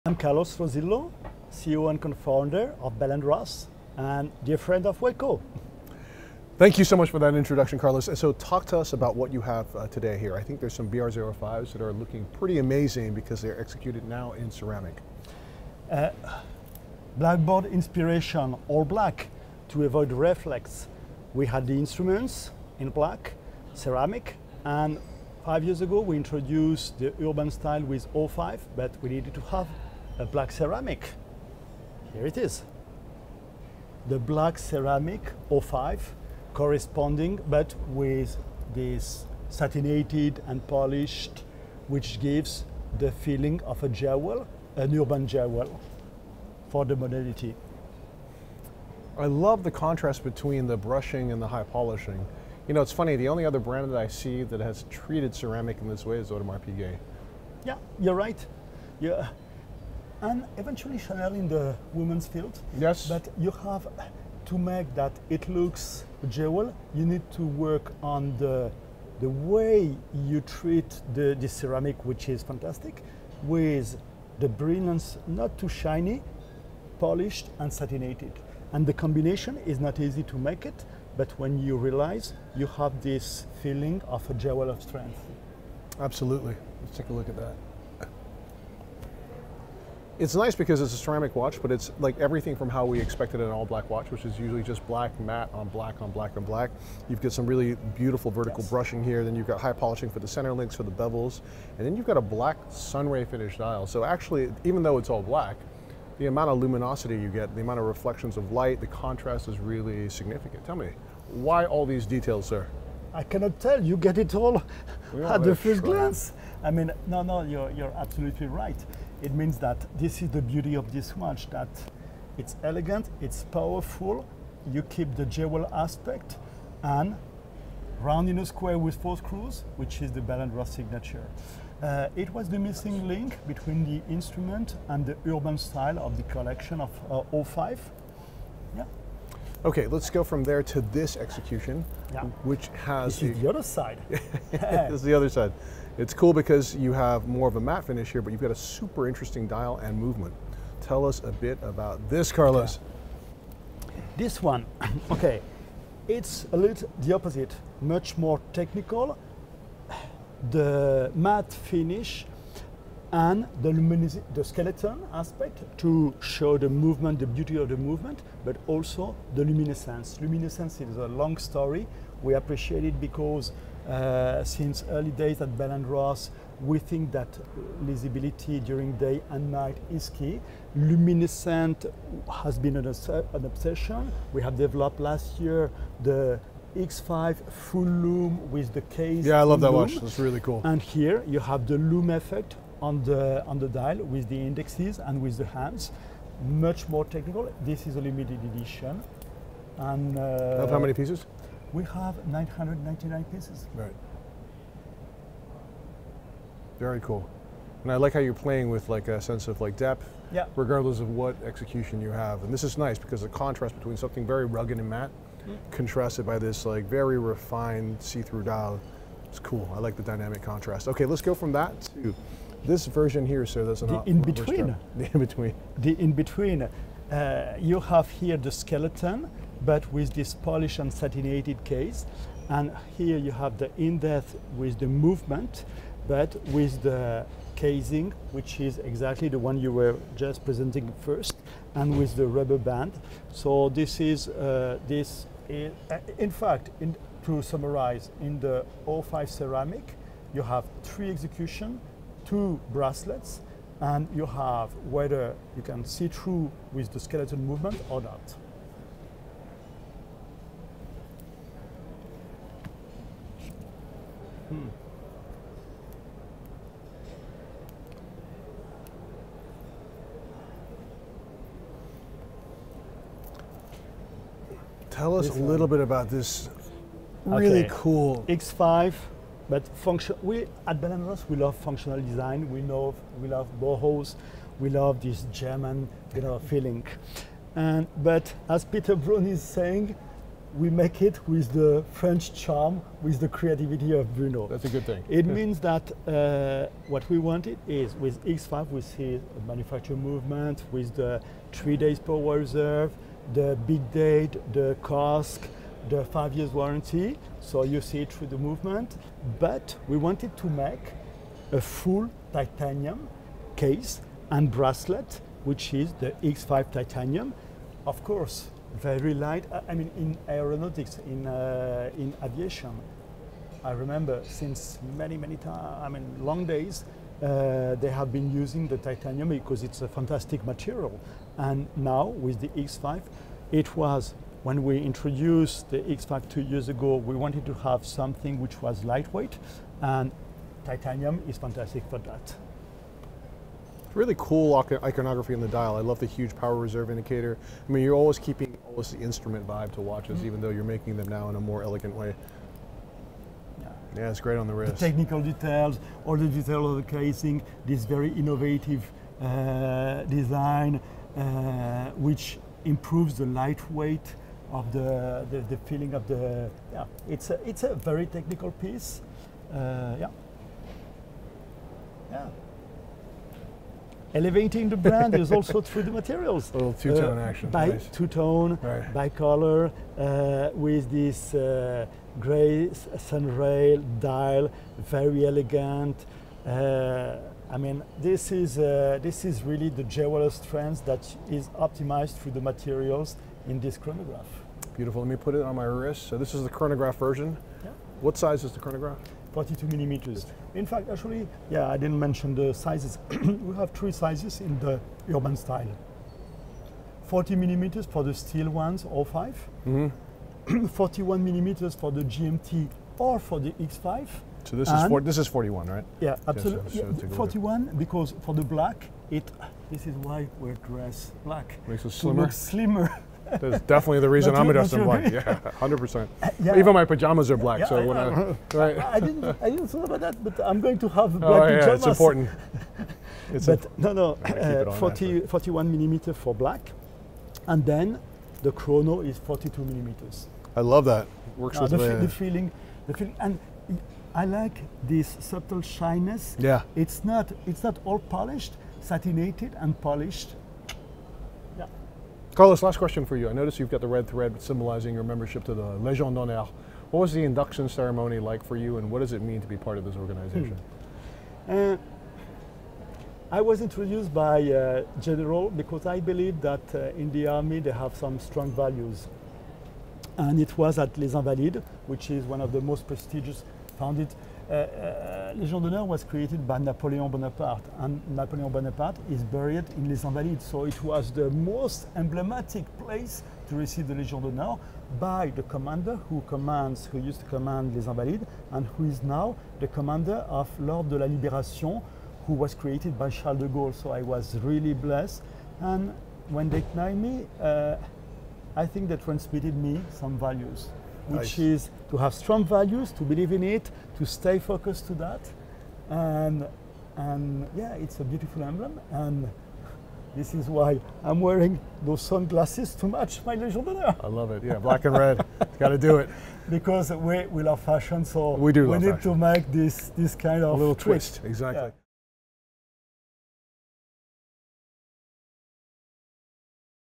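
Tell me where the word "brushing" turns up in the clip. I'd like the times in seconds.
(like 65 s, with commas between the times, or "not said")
50 s, 98 s.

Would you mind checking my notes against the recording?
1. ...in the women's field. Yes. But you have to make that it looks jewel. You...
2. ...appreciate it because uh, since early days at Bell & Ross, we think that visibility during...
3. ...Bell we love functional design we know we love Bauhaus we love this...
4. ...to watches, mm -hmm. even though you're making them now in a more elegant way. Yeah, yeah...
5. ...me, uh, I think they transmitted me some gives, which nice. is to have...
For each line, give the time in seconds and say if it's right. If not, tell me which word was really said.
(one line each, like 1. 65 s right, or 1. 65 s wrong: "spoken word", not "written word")
1. 61 s right
2. 172 s right
3. 280 s right
4. 349 s right
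5. 496 s wrong: "values", not "gives".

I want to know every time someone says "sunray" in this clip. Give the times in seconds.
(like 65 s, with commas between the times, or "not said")
102 s, 382 s.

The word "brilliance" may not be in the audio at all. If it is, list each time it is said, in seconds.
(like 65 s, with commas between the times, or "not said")
74 s.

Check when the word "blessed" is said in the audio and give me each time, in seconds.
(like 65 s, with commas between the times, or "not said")
494 s.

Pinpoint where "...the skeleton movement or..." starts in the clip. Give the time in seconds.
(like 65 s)
256 s.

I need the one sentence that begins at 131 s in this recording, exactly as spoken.
Uh, it was the missing link between the instrument and the urban style of the collection of uh, 05.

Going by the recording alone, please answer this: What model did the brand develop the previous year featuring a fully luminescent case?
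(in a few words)
X5 full loom.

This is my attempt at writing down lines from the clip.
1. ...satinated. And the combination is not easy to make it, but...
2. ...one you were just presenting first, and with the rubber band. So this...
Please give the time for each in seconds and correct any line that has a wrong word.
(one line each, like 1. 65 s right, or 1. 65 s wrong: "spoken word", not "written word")
1. 77 s right
2. 239 s right.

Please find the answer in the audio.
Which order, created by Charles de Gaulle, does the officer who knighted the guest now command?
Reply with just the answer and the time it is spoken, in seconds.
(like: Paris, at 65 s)
l'Ordre de la Libération, at 490 s.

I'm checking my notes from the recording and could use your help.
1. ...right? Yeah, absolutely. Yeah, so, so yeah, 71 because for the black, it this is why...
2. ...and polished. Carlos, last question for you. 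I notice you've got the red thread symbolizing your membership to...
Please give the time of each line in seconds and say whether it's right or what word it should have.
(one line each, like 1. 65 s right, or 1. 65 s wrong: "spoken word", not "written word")
1. 415 s wrong: "41", not "71"
2. 449 s right.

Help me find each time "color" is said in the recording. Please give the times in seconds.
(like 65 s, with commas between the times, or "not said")
379 s.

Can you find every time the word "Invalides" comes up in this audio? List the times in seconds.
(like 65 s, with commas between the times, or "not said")
471 s, 480 s, 487 s.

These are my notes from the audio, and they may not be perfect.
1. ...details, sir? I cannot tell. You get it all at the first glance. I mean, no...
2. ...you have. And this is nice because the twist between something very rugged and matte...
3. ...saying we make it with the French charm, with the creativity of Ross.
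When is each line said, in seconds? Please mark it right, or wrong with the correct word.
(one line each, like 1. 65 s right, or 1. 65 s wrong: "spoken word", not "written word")
1. 112 s right
2. 212 s wrong: "contrast", not "twist"
3. 289 s wrong: "Bruno", not "Ross".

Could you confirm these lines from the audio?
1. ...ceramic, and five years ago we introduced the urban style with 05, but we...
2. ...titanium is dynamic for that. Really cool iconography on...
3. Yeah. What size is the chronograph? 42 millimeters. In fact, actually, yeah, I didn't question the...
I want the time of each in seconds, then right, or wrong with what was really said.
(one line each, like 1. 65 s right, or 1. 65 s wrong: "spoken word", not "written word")
1. 23 s right
2. 340 s wrong: "fantastic", not "dynamic"
3. 397 s wrong: "mention", not "question".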